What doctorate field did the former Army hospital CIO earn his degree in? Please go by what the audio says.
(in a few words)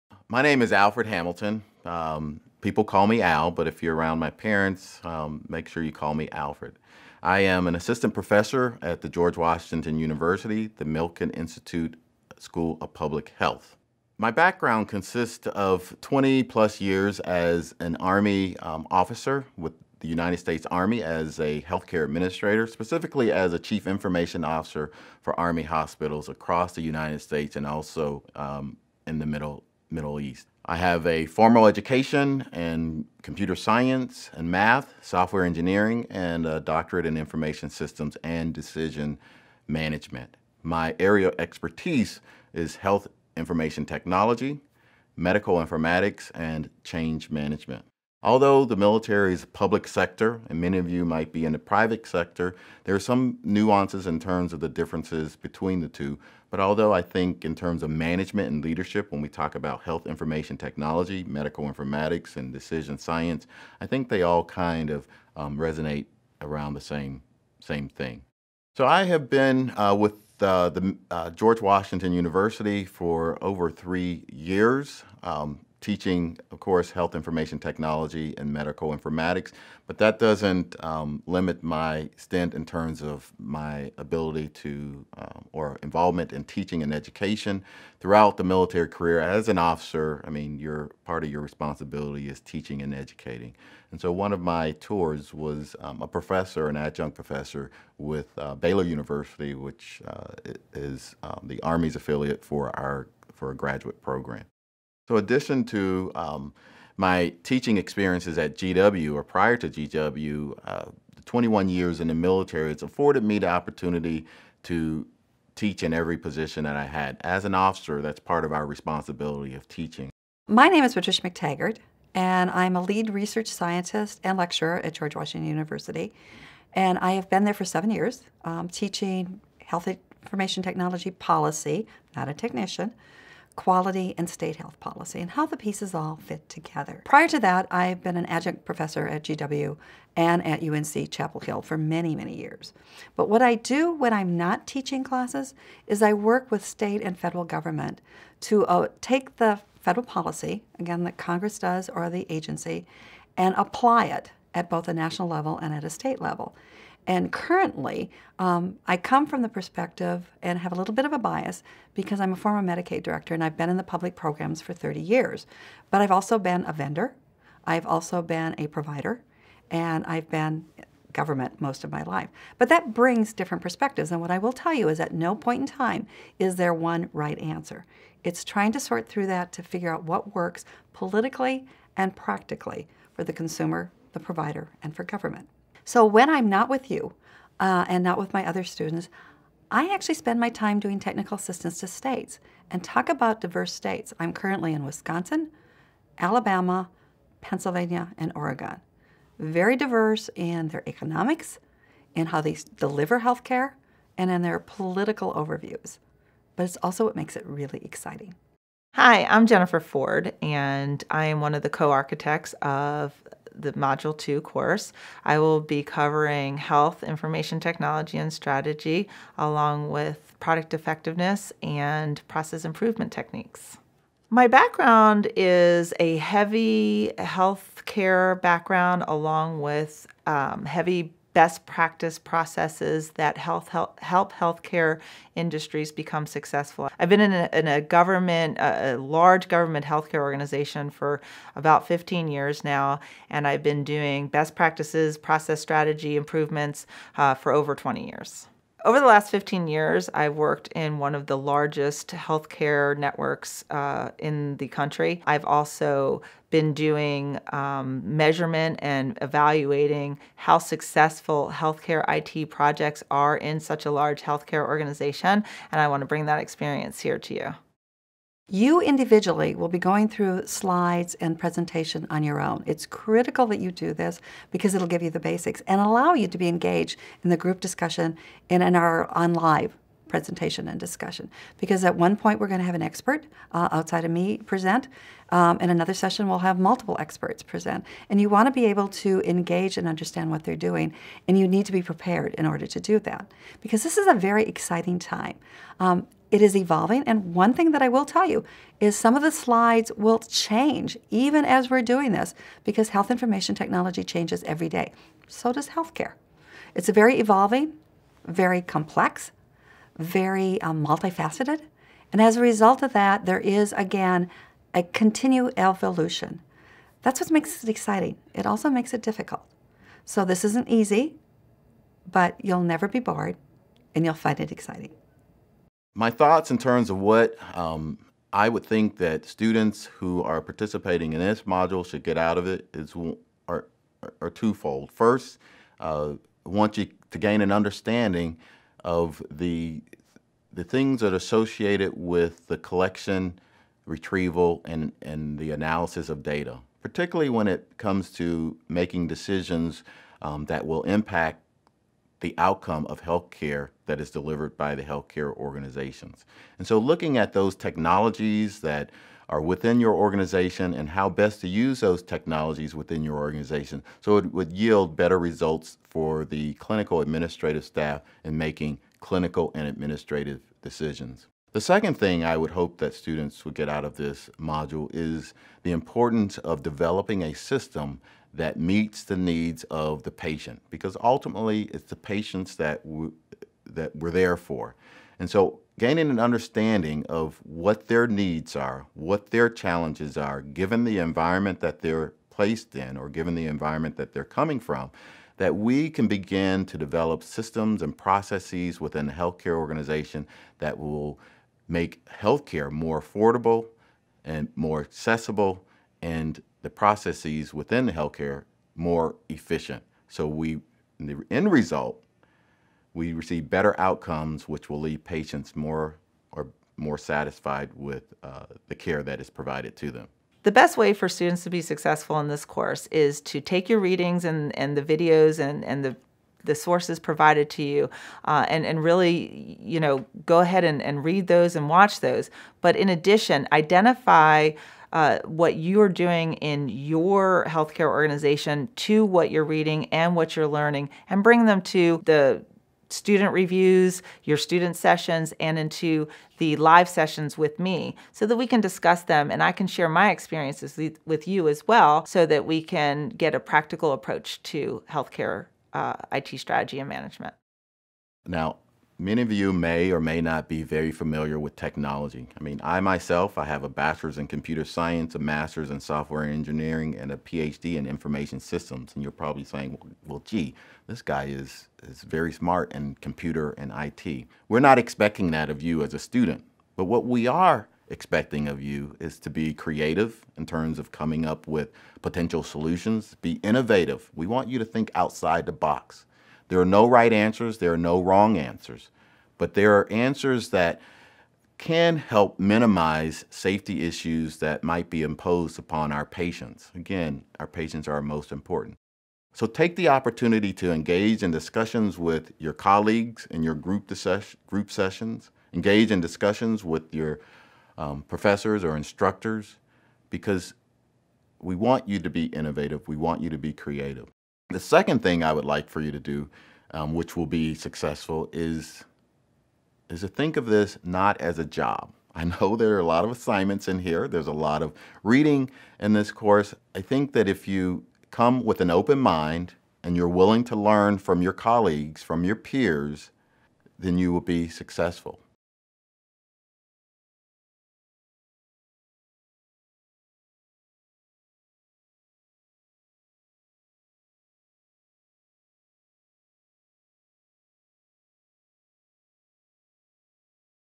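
information systems and decision management.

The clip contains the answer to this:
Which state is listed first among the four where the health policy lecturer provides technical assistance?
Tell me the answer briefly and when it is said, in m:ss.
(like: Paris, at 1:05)
Wisconsin, at 3:14.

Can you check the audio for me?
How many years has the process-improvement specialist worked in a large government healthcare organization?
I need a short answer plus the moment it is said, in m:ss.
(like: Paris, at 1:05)
15, at 4:01.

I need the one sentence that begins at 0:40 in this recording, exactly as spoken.
My area of expertise is health information technology, medical informatics, and change management.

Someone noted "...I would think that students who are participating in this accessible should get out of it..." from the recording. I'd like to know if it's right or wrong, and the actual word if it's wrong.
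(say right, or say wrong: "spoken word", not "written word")
wrong: "module", not "accessible".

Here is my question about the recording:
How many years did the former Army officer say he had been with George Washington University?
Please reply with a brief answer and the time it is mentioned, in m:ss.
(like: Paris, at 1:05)
over 3 years, at 1:13.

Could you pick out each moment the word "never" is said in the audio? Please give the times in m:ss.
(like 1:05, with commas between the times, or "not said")
5:22.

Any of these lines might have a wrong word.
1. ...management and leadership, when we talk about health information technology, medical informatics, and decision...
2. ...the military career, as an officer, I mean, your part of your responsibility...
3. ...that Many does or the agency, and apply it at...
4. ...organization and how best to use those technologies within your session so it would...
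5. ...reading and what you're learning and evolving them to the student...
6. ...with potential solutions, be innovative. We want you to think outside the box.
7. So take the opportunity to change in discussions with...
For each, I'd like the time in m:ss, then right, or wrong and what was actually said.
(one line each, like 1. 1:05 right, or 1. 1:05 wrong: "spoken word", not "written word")
1. 0:57 right
2. 1:28 right
3. 2:31 wrong: "Congress", not "Many"
4. 5:59 wrong: "organization", not "session"
5. 7:19 wrong: "bring", not "evolving"
6. 8:01 right
7. 8:19 wrong: "engage", not "change".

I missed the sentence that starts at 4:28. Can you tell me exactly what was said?
You individually will be going through slides and presentation on your own.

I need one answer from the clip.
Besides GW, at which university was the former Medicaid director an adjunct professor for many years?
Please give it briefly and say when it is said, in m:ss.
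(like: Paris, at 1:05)
UNC Chapel Hill, at 2:20.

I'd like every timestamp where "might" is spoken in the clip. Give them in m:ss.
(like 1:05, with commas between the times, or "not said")
0:51, 8:14.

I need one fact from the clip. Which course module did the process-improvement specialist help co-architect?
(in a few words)
Module 2.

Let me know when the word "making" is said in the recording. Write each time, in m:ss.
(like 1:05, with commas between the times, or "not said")
5:48, 6:08.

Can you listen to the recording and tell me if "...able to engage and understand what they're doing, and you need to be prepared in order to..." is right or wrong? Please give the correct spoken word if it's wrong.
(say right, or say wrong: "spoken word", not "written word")
right.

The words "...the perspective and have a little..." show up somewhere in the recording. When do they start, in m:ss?
2:39.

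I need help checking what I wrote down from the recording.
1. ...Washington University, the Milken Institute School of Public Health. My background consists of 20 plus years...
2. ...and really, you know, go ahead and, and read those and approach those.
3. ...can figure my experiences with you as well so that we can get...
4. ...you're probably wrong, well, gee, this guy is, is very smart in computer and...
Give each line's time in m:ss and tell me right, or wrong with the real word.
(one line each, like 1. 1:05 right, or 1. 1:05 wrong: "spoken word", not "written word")
1. 0:09 right
2. 7:08 wrong: "watch", not "approach"
3. 7:29 wrong: "share", not "figure"
4. 7:49 wrong: "saying", not "wrong".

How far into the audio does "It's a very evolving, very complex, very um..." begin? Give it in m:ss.
5:06.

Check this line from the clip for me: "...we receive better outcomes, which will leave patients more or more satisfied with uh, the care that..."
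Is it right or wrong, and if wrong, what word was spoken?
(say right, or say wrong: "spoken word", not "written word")
right.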